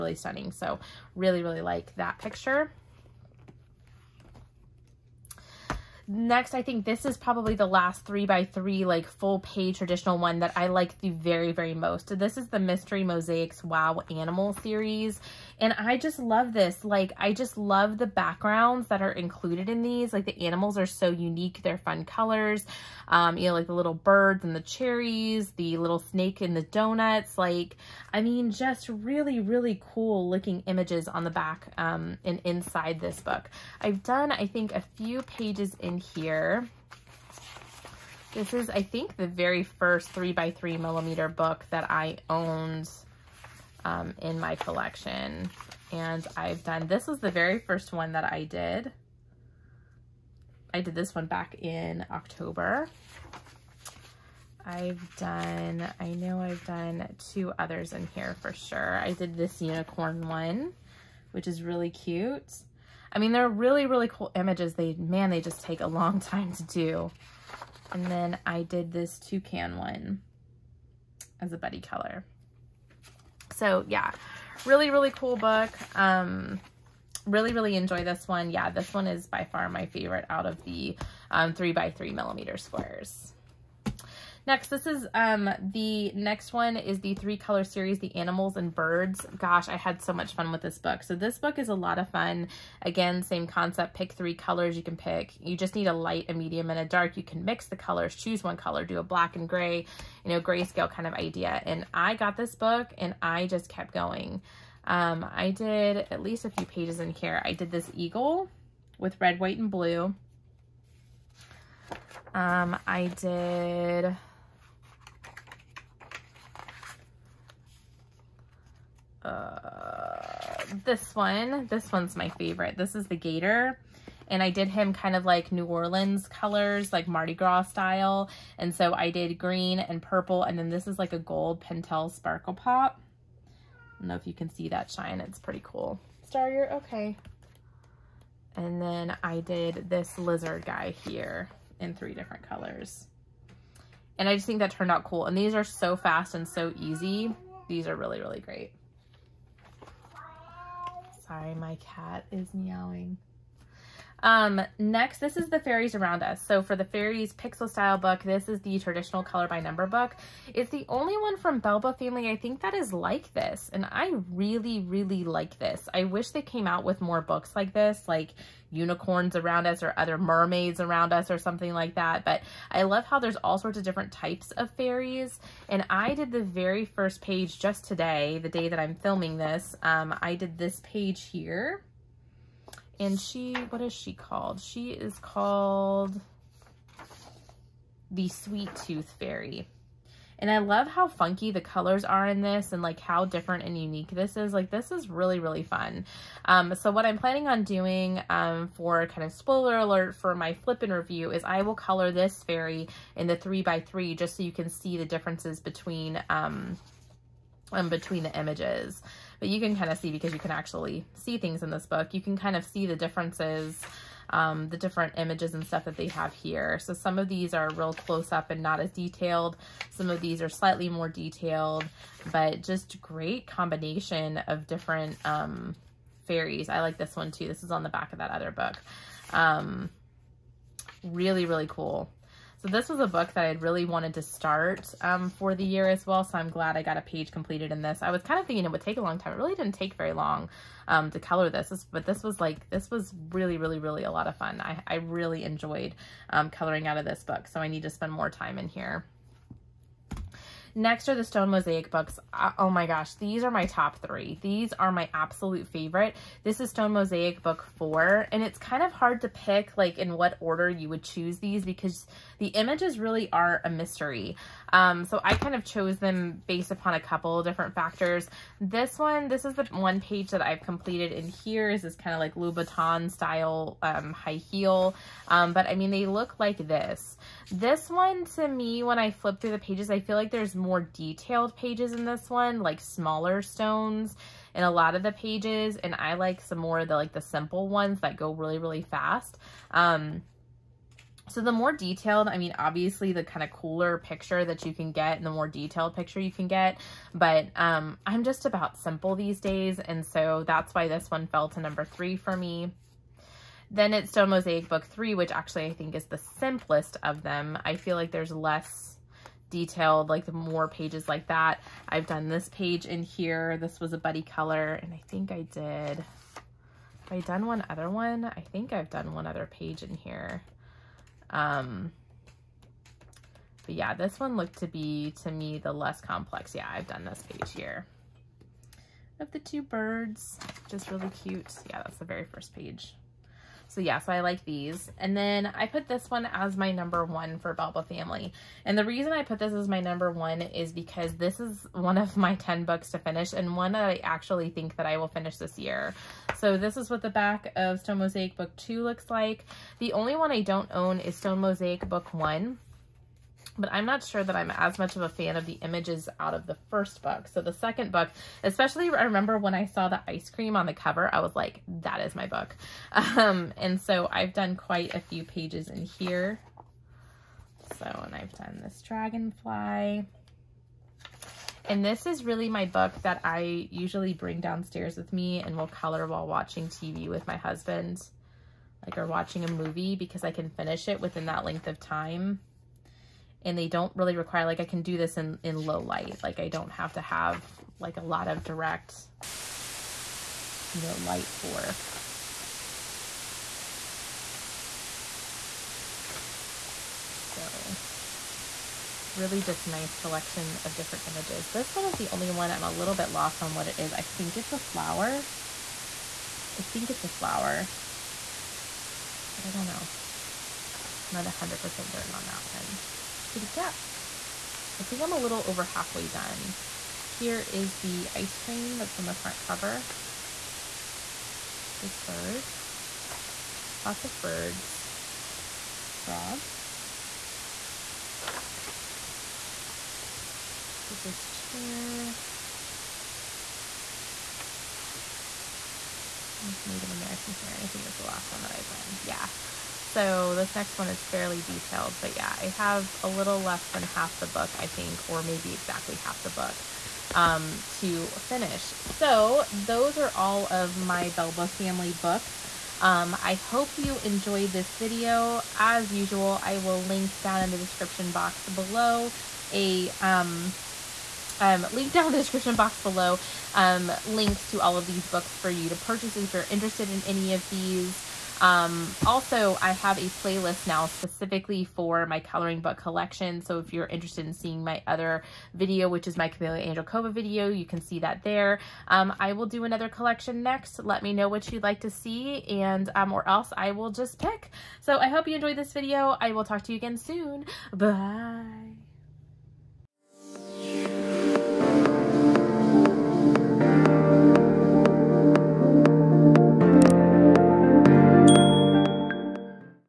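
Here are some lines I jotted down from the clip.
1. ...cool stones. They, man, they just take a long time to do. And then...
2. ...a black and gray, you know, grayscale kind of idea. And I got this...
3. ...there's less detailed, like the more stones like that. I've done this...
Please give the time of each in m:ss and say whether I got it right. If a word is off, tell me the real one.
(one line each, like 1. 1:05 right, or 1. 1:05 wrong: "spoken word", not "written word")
1. 1:04 wrong: "images", not "stones"
2. 1:38 right
3. 5:08 wrong: "pages", not "stones".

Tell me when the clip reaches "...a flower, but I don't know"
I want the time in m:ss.
6:47.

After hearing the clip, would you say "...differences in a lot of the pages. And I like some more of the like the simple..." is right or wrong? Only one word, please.
wrong.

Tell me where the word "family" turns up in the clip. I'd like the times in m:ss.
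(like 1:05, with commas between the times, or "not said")
2:41, 5:37, 7:31.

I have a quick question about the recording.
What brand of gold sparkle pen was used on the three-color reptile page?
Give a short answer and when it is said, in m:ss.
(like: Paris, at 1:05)
Pentel Sparkle Pop, at 2:11.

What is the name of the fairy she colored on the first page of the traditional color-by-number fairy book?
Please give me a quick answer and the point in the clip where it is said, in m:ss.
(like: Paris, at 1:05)
Sweet Tooth Fairy, at 3:08.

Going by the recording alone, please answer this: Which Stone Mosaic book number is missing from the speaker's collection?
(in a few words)
1.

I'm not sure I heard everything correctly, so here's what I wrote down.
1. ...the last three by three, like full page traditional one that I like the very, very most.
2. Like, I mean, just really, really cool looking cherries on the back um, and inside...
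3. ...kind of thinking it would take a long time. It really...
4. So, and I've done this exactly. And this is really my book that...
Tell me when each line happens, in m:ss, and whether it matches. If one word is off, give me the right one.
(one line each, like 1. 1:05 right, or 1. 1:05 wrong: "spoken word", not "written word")
1. 0:07 right
2. 0:27 wrong: "images", not "cherries"
3. 3:58 right
4. 6:07 wrong: "dragonfly", not "exactly".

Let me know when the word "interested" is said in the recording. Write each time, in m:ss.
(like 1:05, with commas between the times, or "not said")
7:46, 7:53.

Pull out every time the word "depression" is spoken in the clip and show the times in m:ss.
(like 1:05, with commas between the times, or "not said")
not said.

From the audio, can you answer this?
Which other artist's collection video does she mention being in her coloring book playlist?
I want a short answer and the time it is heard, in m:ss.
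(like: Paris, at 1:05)
Camellia Angelkova, at 7:56.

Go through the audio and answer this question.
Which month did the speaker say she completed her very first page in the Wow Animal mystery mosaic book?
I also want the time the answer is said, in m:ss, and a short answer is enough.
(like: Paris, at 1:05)
October, at 0:52.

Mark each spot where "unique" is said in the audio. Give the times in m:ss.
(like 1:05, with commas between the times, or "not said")
0:21, 3:13.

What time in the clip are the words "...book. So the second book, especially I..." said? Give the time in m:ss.
5:57.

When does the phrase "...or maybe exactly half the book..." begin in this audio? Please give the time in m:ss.
7:25.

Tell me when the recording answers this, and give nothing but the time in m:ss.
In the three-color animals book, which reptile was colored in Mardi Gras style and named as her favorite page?
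2:03.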